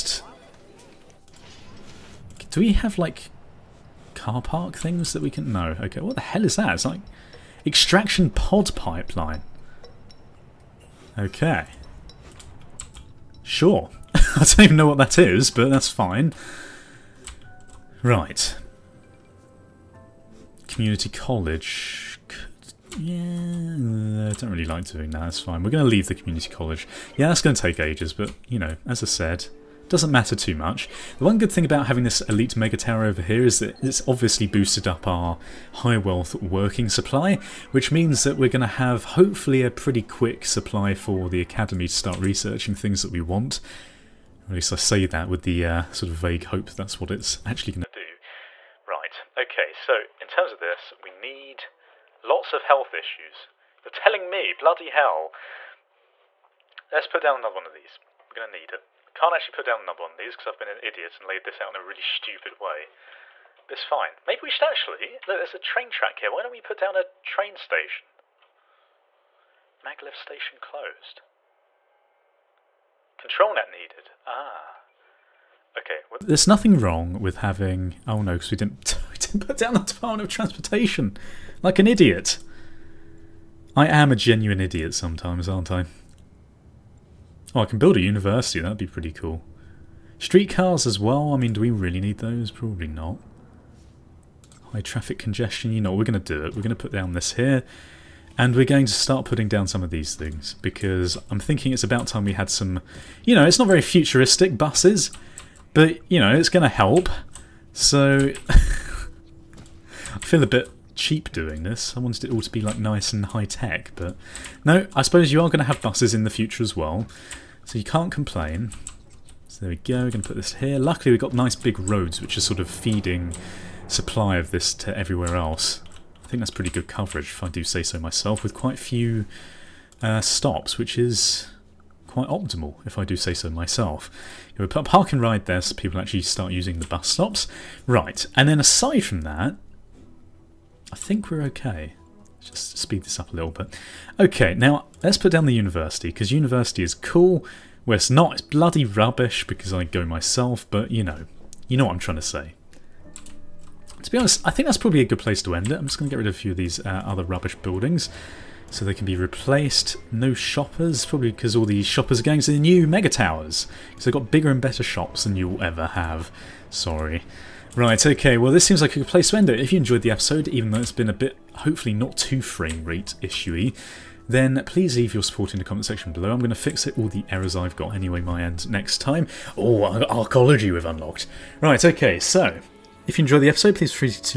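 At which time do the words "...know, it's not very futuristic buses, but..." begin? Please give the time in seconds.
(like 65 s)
103 s.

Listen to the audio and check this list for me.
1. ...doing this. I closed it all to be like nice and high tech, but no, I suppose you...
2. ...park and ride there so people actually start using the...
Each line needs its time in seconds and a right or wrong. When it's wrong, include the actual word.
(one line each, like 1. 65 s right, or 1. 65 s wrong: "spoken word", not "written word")
1. 111 s wrong: "wanted", not "closed"
2. 134 s right.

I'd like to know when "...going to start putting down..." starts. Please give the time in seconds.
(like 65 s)
98 s.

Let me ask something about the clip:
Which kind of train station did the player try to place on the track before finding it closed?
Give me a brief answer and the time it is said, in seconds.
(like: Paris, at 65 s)
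Maglev station, at 69 s.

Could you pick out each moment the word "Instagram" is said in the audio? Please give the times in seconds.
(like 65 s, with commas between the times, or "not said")
not said.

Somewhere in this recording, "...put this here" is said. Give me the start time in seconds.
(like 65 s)
120 s.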